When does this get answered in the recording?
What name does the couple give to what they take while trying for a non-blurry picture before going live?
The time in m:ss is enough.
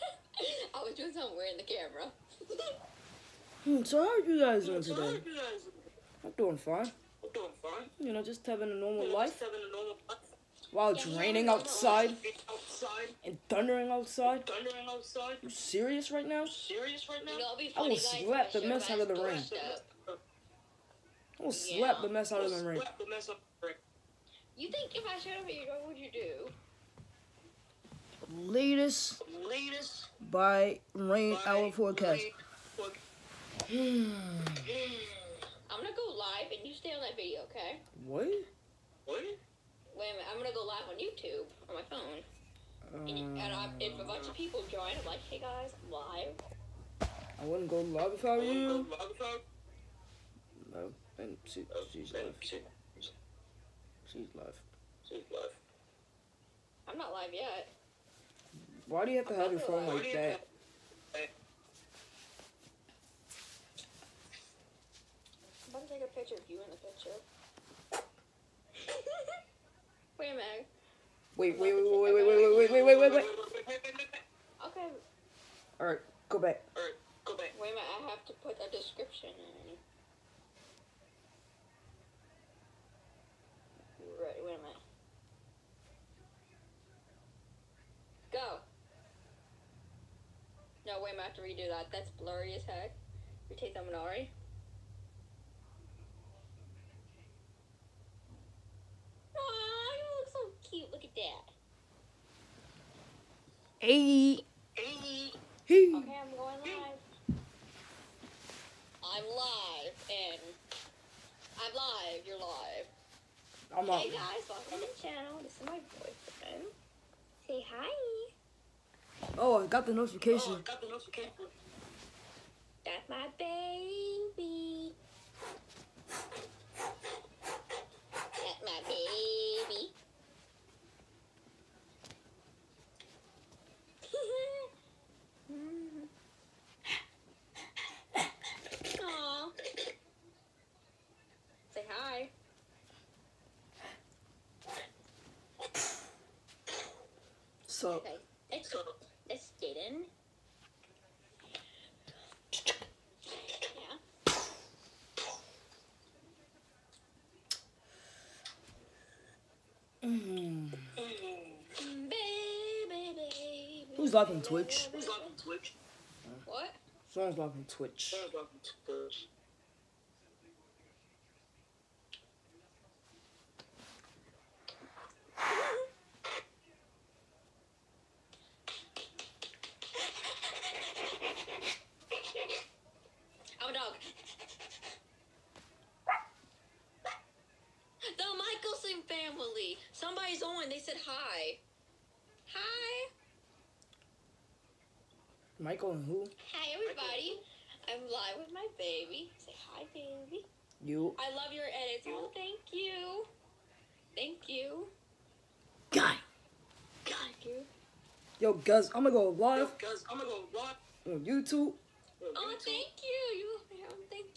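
1:33.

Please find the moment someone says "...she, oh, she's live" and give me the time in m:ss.
0:51.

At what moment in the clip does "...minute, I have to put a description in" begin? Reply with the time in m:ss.
1:17.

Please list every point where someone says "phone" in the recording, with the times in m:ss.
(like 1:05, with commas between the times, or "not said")
0:41, 0:59.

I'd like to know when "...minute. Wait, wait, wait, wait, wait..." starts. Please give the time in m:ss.
1:10.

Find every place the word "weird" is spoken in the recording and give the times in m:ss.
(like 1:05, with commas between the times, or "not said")
0:01.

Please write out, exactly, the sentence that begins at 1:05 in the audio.
I'm about to take a picture of you in the picture.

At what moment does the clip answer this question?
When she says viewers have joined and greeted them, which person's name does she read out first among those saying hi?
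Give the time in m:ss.
3:15.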